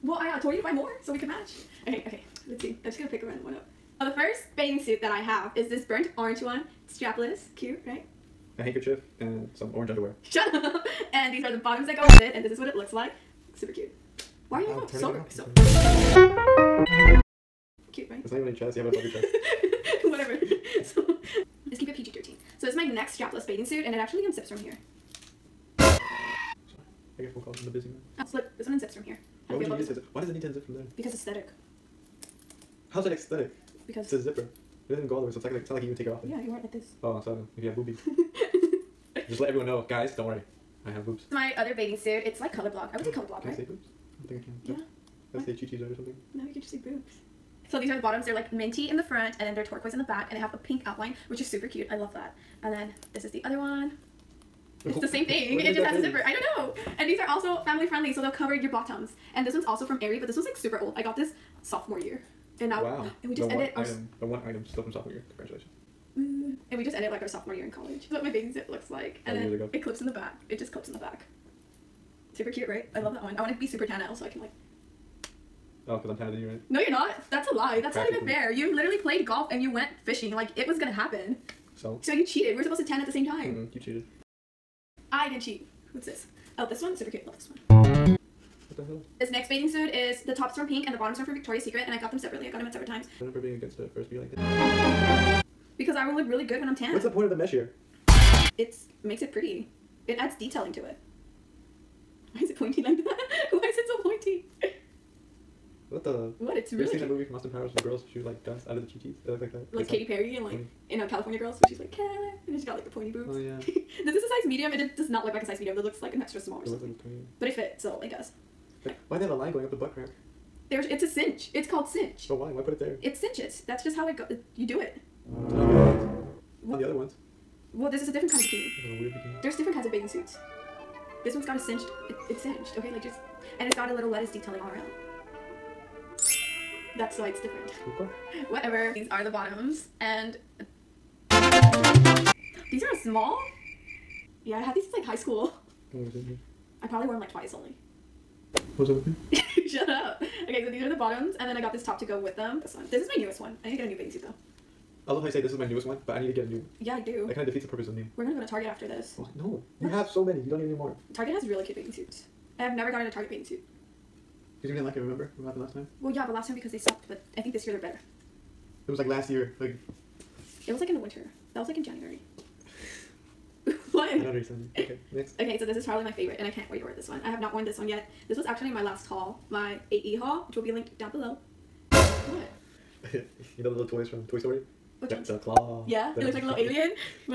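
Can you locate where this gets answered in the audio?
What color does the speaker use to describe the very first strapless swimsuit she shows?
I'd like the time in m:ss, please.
0:05.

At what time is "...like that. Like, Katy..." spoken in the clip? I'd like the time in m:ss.
1:49.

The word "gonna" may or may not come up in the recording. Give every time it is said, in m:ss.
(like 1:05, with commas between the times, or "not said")
0:02, 1:20, 2:38.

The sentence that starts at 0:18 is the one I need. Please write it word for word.
You have it above your chest.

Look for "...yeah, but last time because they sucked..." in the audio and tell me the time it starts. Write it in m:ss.
2:46.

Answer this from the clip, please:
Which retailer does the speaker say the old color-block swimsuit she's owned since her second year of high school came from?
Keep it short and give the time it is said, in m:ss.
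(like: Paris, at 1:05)
Aerie, at 1:00.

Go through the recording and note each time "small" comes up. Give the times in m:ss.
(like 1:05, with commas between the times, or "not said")
1:56, 2:23.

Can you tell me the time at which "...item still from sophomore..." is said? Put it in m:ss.
1:04.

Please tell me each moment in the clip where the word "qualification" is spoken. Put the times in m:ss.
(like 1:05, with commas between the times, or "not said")
not said.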